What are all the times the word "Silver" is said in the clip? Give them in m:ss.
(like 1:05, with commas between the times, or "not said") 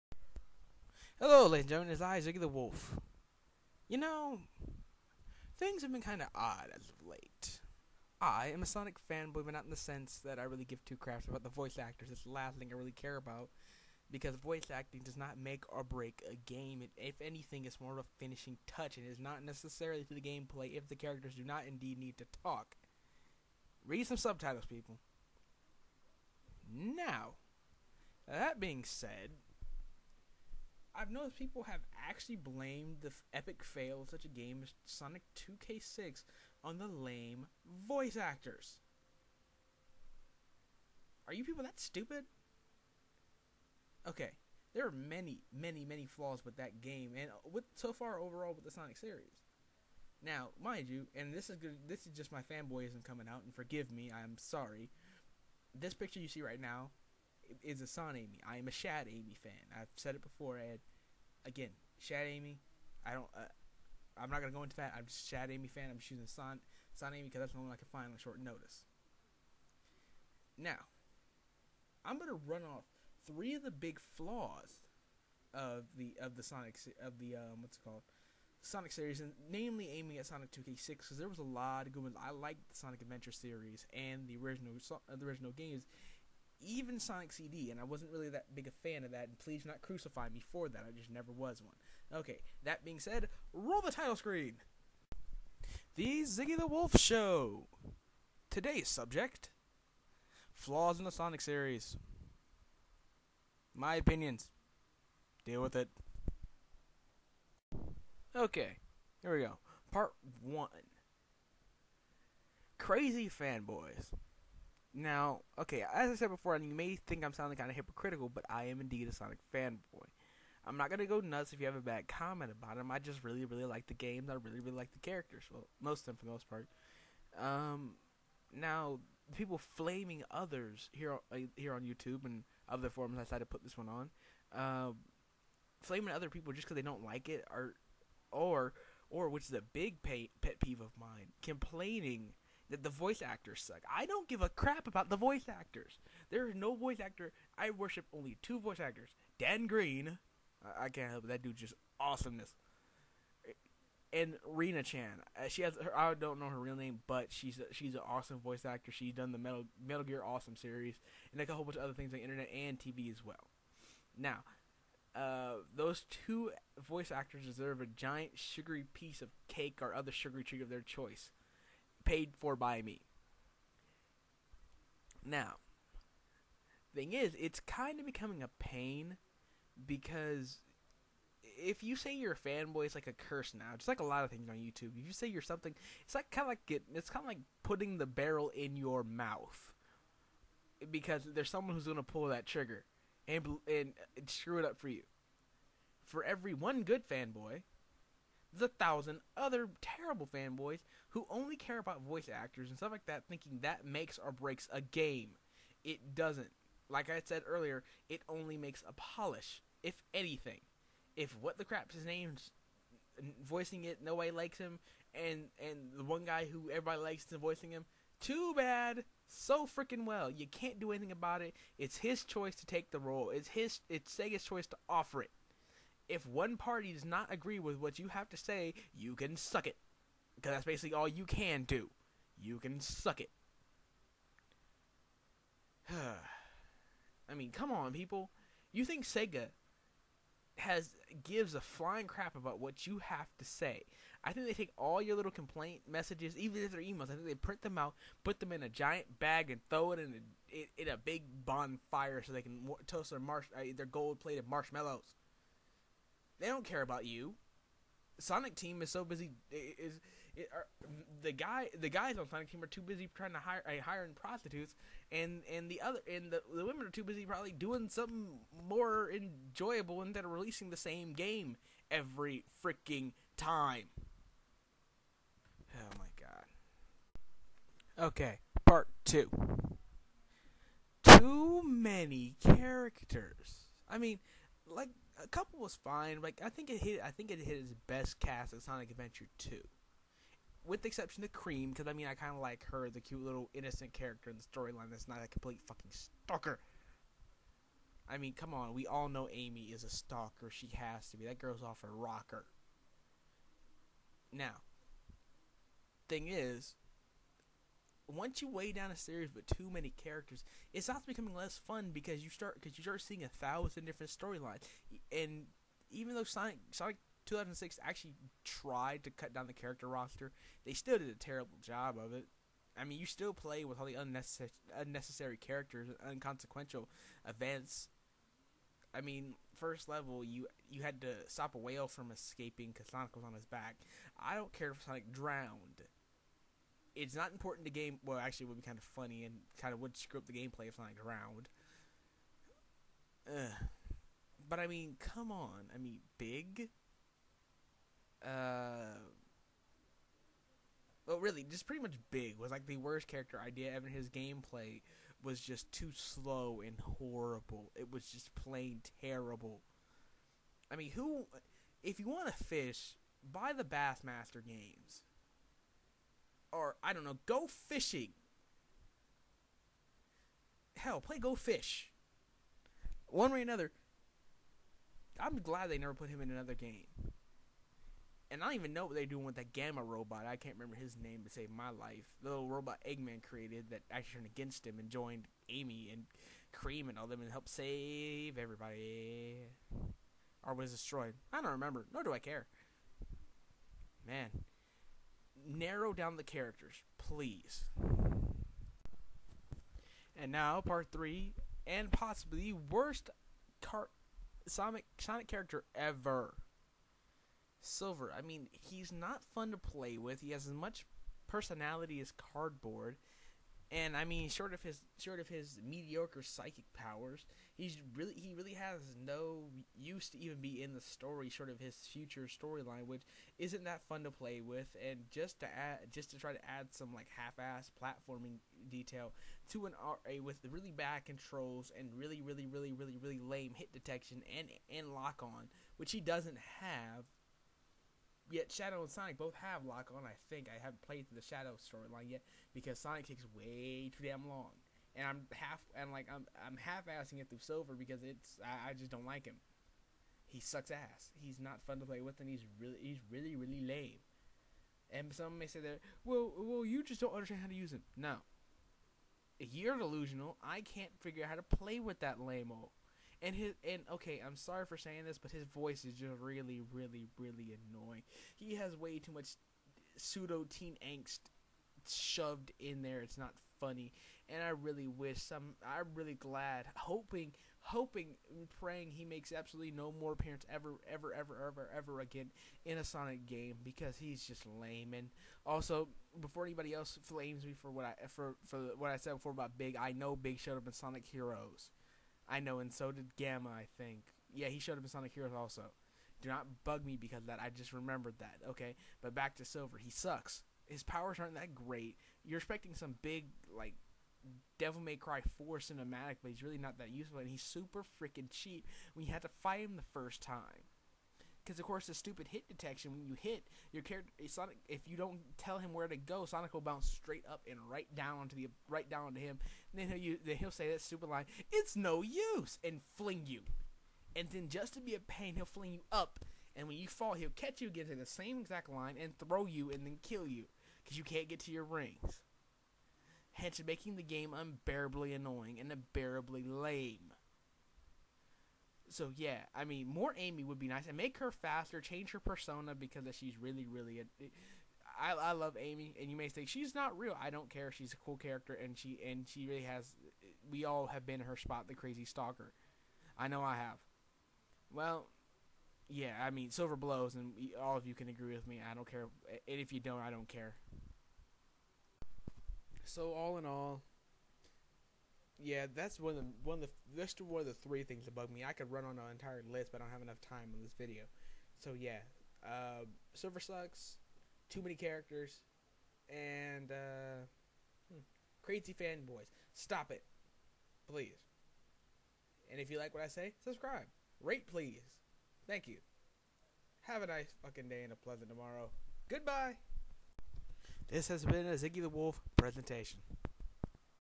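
6:47, 7:27, 8:19, 9:16, 9:33.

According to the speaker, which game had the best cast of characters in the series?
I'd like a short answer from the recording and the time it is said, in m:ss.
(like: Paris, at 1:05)
Sonic Adventure Two, at 4:48.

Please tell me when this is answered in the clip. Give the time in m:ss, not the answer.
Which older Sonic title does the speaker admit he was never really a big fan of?
1:26.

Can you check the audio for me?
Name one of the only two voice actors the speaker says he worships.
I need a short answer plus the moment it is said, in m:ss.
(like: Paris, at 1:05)
Dan Green, at 2:29.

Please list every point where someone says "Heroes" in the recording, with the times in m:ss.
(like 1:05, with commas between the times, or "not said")
8:11, 8:15.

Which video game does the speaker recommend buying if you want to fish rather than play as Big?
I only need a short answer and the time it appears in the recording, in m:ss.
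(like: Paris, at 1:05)
Bassmaster, at 6:03.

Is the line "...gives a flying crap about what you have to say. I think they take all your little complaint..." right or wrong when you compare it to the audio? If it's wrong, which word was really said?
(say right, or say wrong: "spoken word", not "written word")
right.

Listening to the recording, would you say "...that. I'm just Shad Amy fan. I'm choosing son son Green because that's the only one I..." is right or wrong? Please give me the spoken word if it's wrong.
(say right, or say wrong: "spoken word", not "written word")
wrong: "Amy", not "Green".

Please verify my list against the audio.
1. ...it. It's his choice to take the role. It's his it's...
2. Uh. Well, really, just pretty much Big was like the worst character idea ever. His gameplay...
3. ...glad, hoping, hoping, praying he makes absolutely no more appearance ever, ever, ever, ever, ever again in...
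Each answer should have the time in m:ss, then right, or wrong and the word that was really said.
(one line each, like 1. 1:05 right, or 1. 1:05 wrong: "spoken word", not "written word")
1. 3:41 right
2. 5:48 right
3. 7:56 right.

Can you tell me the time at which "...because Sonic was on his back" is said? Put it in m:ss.
5:32.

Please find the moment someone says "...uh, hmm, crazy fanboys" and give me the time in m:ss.
9:36.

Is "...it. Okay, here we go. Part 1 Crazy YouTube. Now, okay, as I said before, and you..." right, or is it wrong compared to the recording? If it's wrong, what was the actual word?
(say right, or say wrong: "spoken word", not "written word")
wrong: "Fanboys", not "YouTube".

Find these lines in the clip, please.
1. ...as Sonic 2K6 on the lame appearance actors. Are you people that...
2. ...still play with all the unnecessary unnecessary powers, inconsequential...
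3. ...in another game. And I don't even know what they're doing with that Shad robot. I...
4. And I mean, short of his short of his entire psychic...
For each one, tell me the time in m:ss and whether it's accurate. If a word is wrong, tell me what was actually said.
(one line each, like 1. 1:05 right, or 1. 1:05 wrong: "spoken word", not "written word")
1. 0:34 wrong: "voice", not "appearance"
2. 5:23 wrong: "characters", not "powers"
3. 6:16 wrong: "Gamma", not "Shad"
4. 6:53 wrong: "mediocre", not "entire".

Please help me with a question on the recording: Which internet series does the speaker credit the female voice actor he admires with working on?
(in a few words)
Metal Gear Awesome.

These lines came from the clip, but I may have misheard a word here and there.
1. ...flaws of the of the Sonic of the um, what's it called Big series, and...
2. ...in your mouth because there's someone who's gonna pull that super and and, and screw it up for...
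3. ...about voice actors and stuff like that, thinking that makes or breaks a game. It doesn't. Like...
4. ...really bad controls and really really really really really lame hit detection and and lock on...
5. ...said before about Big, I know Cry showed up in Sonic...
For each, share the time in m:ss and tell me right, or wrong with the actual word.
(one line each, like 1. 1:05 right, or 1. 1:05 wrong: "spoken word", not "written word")
1. 1:14 wrong: "Sonic", not "Big"
2. 3:08 wrong: "trigger", not "super"
3. 3:21 right
4. 7:10 right
5. 8:08 wrong: "Big", not "Cry".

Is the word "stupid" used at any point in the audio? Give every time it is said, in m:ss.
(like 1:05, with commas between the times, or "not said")
0:41, 8:31, 8:40.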